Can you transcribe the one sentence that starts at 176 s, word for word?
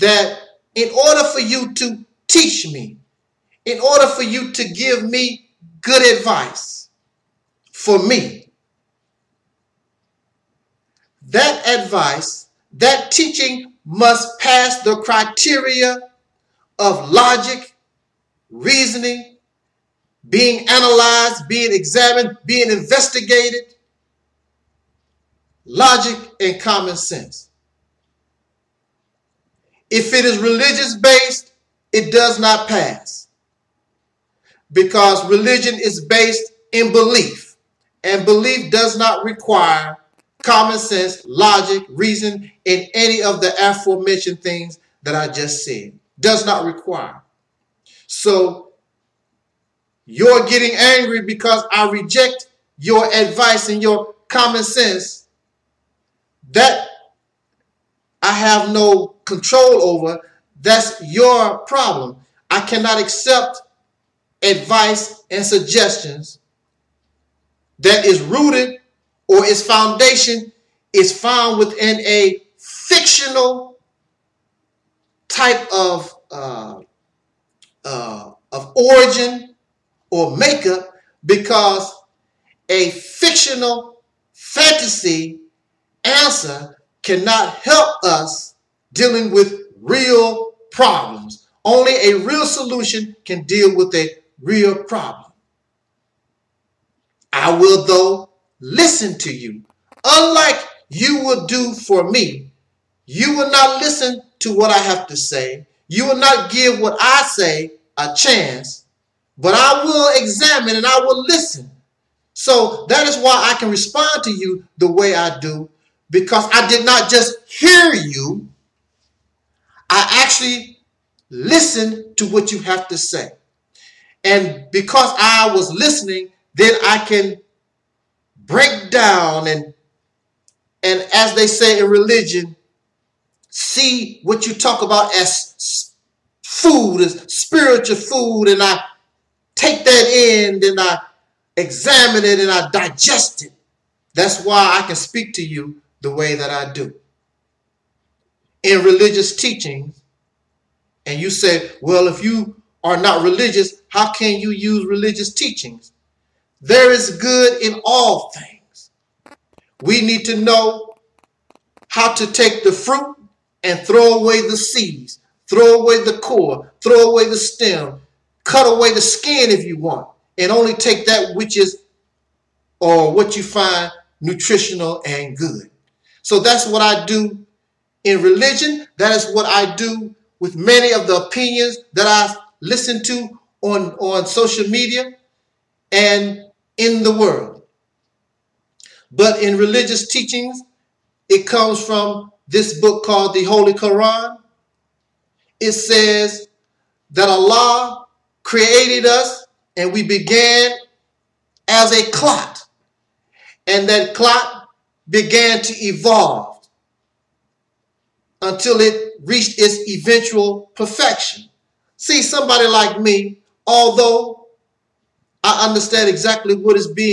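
So that's what I do in religion.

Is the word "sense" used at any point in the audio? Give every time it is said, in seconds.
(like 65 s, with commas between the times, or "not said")
26 s, 40 s, 54 s.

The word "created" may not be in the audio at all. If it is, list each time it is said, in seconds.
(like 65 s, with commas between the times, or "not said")
198 s.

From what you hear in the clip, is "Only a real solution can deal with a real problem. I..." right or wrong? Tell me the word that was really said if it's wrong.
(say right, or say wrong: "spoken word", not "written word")
right.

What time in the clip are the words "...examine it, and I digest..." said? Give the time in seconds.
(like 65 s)
141 s.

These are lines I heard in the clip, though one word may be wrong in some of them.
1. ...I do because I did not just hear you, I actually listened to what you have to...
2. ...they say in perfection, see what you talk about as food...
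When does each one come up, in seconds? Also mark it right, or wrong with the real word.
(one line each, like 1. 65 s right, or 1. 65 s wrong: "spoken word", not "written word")
1. 115 s right
2. 131 s wrong: "religion", not "perfection".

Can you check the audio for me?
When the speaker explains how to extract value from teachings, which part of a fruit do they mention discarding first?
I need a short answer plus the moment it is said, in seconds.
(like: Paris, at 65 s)
seeds, at 164 s.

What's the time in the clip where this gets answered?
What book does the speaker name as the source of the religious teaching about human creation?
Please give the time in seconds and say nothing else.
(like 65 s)
193 s.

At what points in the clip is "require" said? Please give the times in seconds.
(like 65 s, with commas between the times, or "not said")
39 s, 46 s.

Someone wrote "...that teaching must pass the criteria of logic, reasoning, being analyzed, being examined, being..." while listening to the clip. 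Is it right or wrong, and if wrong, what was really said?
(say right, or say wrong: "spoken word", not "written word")
right.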